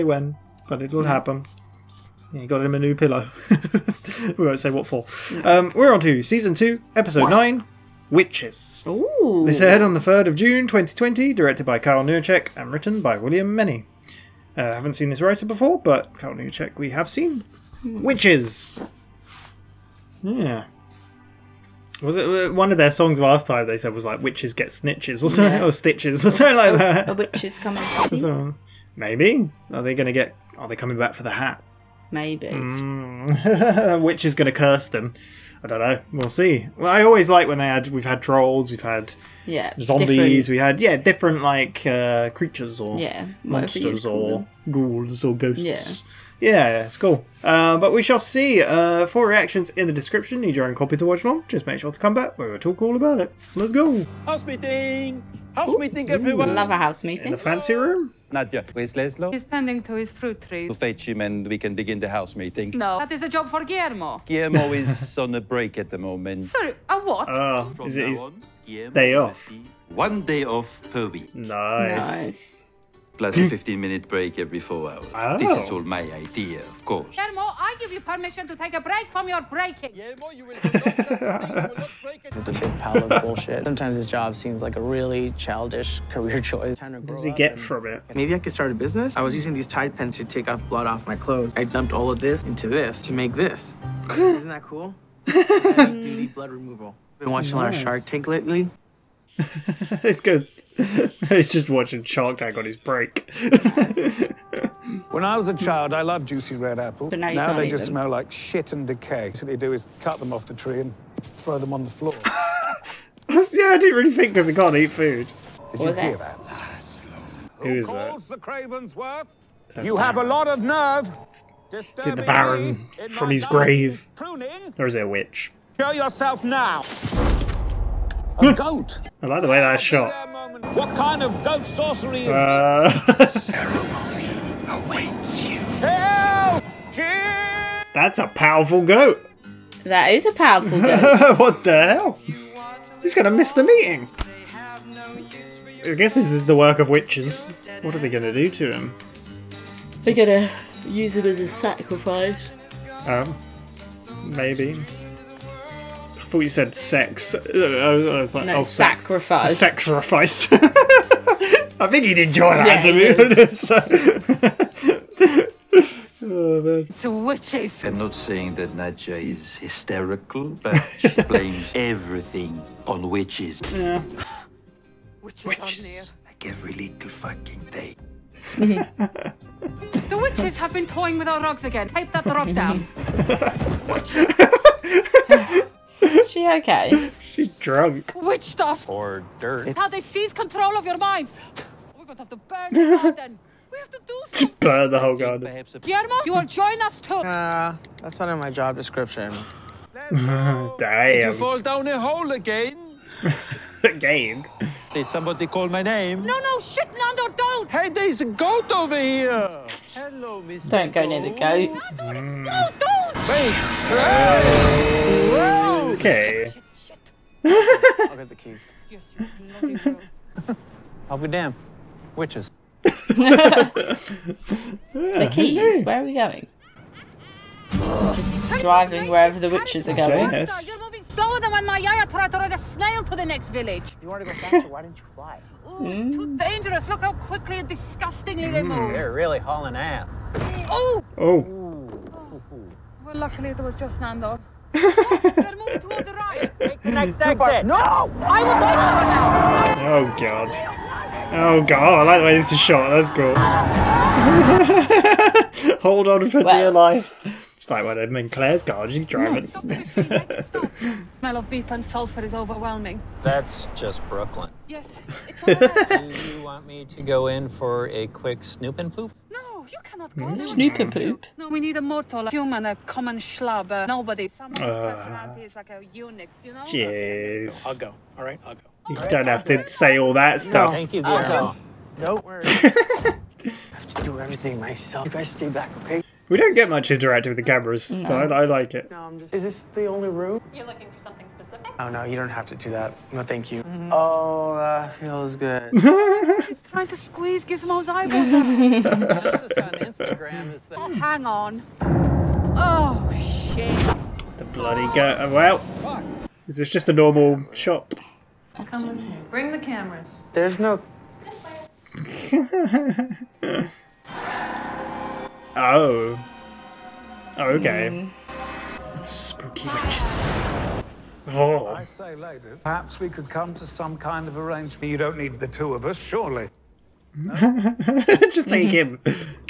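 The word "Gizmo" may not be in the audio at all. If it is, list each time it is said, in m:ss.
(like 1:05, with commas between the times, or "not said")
4:57.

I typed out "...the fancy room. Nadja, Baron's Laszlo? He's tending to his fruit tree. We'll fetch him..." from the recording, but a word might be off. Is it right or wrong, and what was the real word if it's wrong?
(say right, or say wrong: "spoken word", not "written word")
wrong: "Where", not "Baron".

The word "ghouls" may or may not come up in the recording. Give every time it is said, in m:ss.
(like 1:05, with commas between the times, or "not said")
0:44.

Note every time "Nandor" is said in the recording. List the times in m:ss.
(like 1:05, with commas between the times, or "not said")
3:26, 4:03.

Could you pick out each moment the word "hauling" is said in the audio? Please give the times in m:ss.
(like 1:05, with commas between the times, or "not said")
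3:59.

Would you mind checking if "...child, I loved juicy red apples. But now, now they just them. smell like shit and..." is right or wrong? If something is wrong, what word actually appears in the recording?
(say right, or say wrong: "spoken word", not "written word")
right.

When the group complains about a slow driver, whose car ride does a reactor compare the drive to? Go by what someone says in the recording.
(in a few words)
Claire's.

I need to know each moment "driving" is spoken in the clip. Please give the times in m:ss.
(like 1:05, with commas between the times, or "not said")
3:48, 4:19.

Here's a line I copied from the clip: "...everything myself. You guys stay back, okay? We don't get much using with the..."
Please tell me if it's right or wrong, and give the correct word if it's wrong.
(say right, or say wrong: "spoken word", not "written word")
wrong: "interacting", not "using".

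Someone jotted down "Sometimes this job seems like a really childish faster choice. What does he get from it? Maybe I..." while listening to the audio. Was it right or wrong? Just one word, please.
wrong.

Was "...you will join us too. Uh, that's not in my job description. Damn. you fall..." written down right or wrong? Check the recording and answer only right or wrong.
right.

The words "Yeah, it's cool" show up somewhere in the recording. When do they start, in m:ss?
0:46.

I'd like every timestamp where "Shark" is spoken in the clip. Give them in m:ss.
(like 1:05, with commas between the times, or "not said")
1:37, 1:42.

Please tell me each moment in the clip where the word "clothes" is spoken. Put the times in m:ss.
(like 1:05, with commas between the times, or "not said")
1:31.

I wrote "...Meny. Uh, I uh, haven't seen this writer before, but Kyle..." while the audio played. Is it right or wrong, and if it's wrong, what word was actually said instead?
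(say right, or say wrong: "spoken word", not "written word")
right.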